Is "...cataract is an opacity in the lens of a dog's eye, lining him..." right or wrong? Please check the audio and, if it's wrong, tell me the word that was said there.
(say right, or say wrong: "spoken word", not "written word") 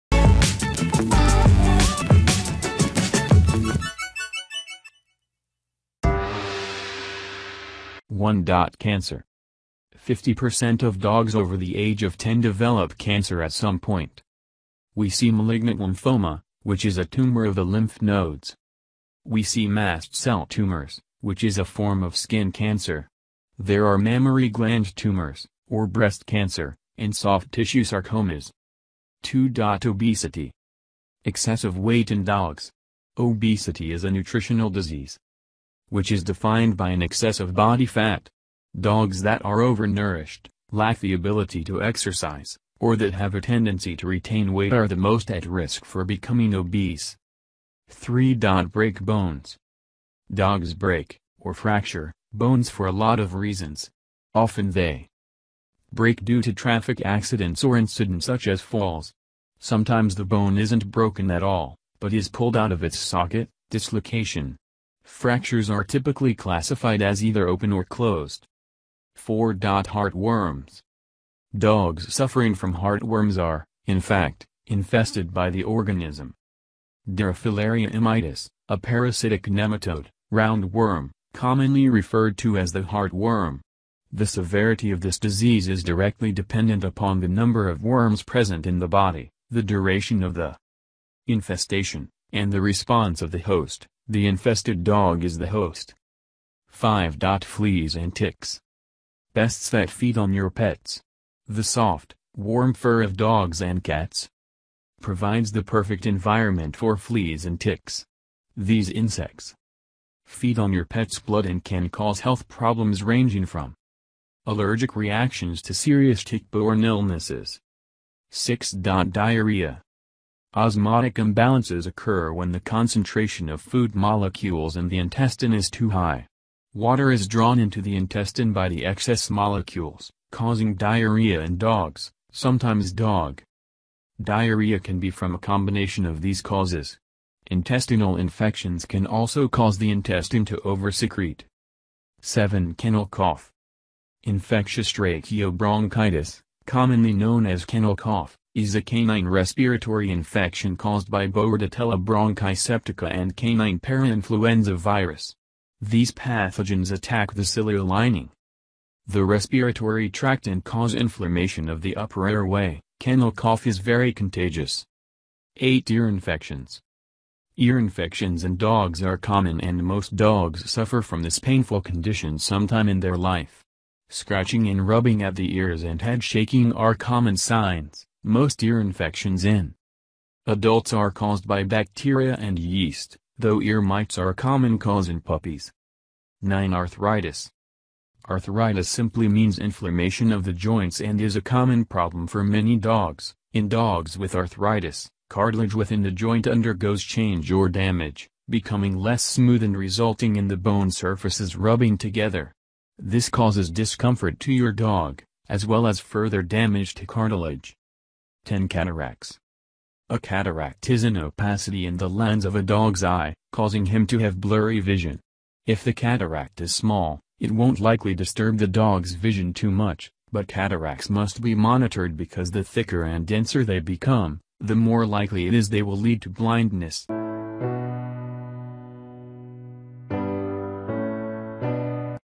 wrong: "causing", not "lining".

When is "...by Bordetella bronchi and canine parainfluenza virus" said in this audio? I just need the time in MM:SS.
02:31.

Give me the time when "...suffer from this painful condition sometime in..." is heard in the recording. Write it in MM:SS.
02:50.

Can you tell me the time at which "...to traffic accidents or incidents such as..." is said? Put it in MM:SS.
00:56.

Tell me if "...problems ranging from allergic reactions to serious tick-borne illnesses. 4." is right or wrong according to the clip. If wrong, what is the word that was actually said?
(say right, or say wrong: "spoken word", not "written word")
wrong: "6", not "4".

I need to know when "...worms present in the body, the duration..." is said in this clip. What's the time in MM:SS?
01:27.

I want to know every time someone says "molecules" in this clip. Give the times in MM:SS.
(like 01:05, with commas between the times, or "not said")
02:03, 02:09.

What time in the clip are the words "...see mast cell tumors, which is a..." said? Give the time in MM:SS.
00:19.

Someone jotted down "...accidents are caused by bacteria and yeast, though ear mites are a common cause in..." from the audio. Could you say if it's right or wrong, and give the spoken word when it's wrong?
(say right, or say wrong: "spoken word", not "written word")
wrong: "adults", not "accidents".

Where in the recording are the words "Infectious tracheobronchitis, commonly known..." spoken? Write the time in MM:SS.
02:24.